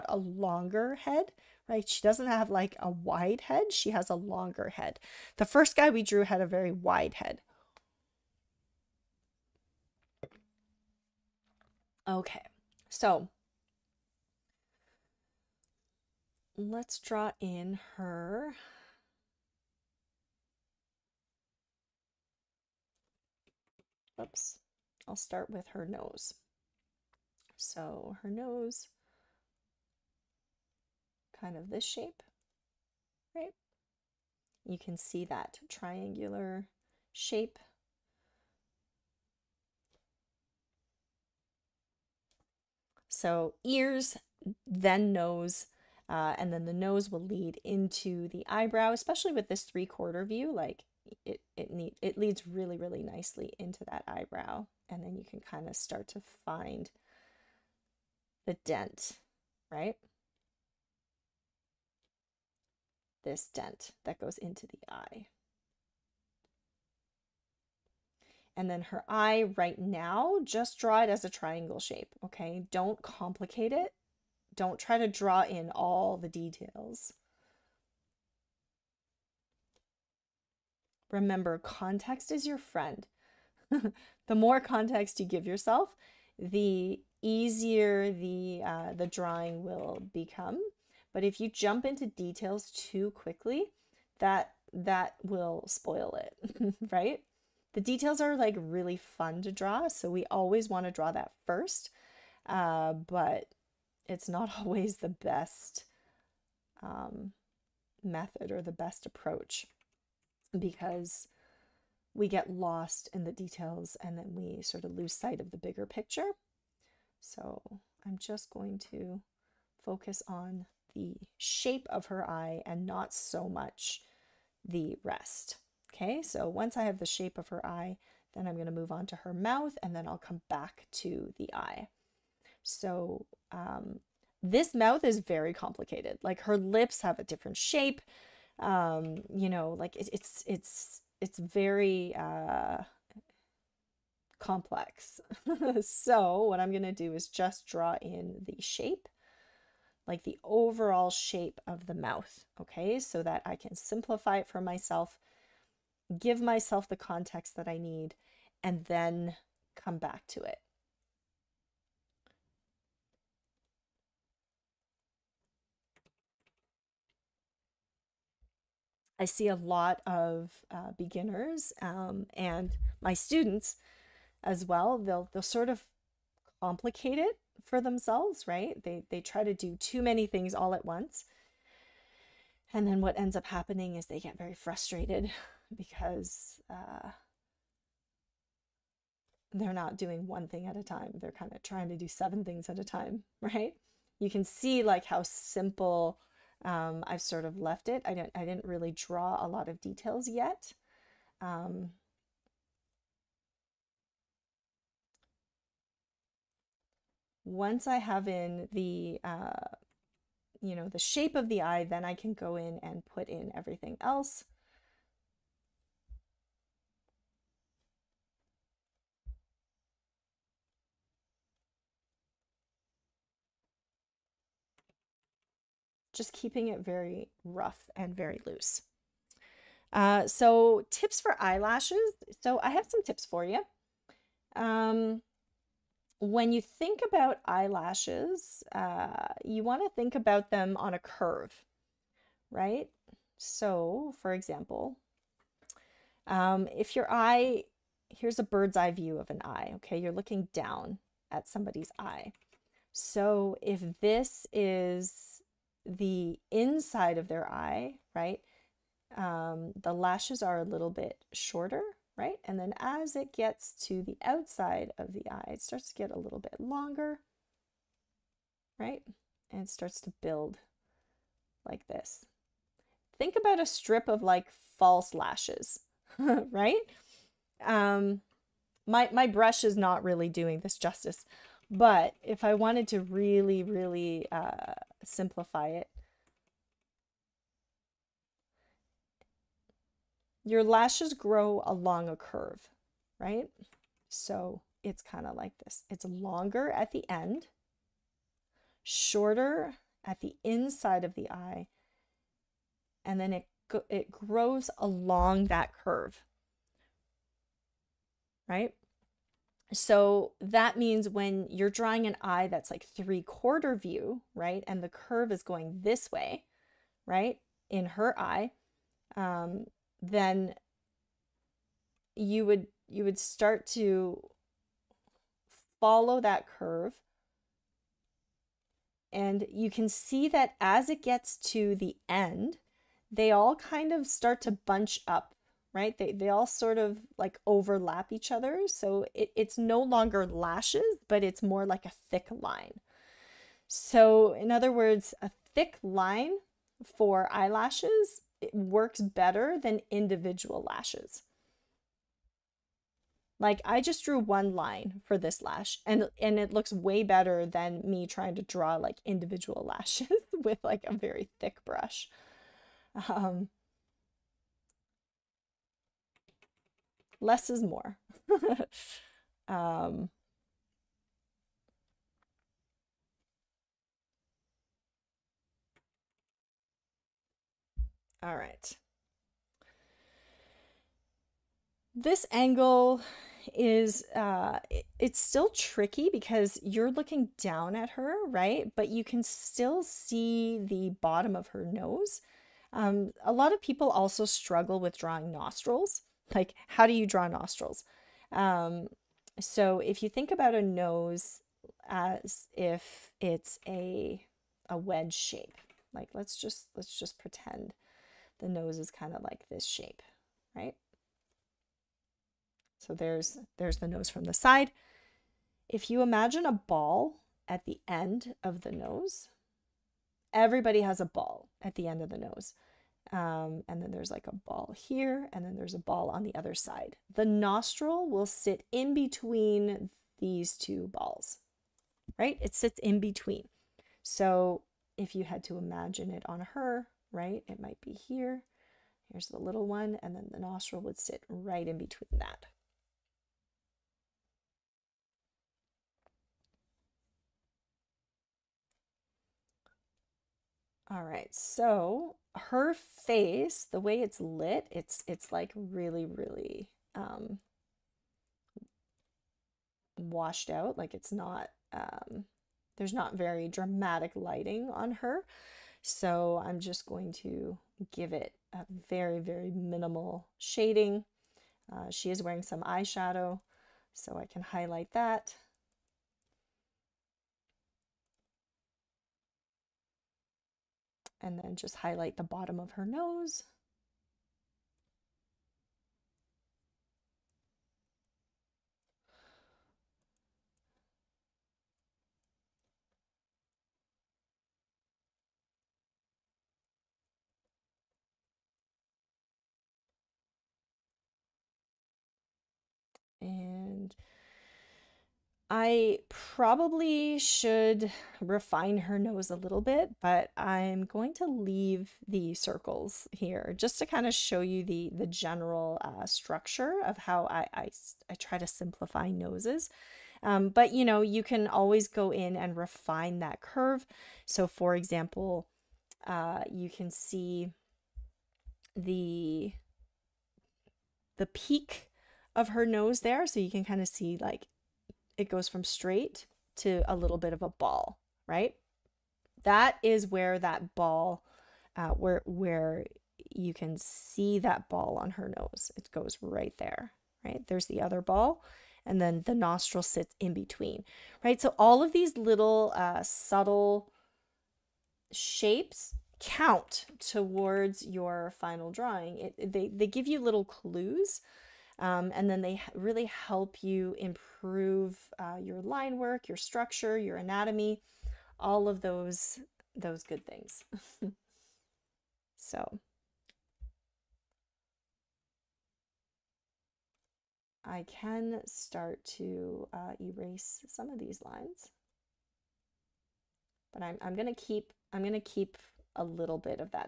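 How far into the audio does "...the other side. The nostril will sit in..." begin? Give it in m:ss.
7:06.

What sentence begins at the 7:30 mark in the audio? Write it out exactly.
All right, so her face, the way it's lit, it's it's like really really um, washed out.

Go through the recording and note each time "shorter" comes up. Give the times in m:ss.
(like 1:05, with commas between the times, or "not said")
4:21, 4:58.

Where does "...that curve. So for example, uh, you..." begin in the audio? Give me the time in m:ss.
8:43.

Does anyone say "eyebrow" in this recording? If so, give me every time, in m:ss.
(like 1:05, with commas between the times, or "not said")
0:48, 0:54.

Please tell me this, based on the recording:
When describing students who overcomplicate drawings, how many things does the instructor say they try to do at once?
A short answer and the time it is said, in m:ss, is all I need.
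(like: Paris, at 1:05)
7, at 3:12.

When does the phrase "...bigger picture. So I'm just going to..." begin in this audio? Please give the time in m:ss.
1:55.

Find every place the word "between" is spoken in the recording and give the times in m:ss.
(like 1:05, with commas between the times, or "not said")
7:08, 7:12, 7:21, 9:10.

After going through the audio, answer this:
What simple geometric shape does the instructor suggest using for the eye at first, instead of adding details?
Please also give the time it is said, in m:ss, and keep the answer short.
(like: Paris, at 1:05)
Triangle, at 1:11.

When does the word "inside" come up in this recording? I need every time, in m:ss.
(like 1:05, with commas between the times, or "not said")
4:16, 5:00.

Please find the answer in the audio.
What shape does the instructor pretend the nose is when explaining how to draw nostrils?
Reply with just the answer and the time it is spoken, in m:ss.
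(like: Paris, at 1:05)
Wedge shape, at 6:44.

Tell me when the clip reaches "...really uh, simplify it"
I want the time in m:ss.
4:43.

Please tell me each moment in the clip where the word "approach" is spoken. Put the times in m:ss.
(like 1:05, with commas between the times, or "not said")
1:49.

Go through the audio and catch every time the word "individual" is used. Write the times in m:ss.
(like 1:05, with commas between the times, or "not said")
5:49, 5:59.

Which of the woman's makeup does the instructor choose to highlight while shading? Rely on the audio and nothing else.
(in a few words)
Eyeshadow.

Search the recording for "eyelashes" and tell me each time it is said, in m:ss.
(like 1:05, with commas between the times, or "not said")
3:51, 3:57, 5:47.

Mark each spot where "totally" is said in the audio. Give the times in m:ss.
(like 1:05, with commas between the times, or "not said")
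not said.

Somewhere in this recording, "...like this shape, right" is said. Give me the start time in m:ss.
6:49.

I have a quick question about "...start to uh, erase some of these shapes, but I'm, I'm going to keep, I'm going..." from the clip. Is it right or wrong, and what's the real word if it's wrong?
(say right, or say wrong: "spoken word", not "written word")
wrong: "lines", not "shapes".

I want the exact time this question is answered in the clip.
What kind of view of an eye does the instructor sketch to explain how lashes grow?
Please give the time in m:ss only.
4:08.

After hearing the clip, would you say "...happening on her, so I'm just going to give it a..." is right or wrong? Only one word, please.
wrong.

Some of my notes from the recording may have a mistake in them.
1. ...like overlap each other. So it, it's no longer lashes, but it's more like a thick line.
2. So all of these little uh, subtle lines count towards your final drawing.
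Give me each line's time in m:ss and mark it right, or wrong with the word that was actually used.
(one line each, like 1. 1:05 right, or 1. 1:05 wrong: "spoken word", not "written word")
1. 5:37 right
2. 9:11 wrong: "shapes", not "lines".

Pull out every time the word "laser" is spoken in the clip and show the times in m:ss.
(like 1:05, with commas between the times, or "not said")
not said.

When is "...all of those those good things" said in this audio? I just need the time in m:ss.
9:28.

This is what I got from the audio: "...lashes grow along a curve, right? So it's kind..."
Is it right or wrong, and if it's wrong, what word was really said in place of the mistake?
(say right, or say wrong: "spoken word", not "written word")
right.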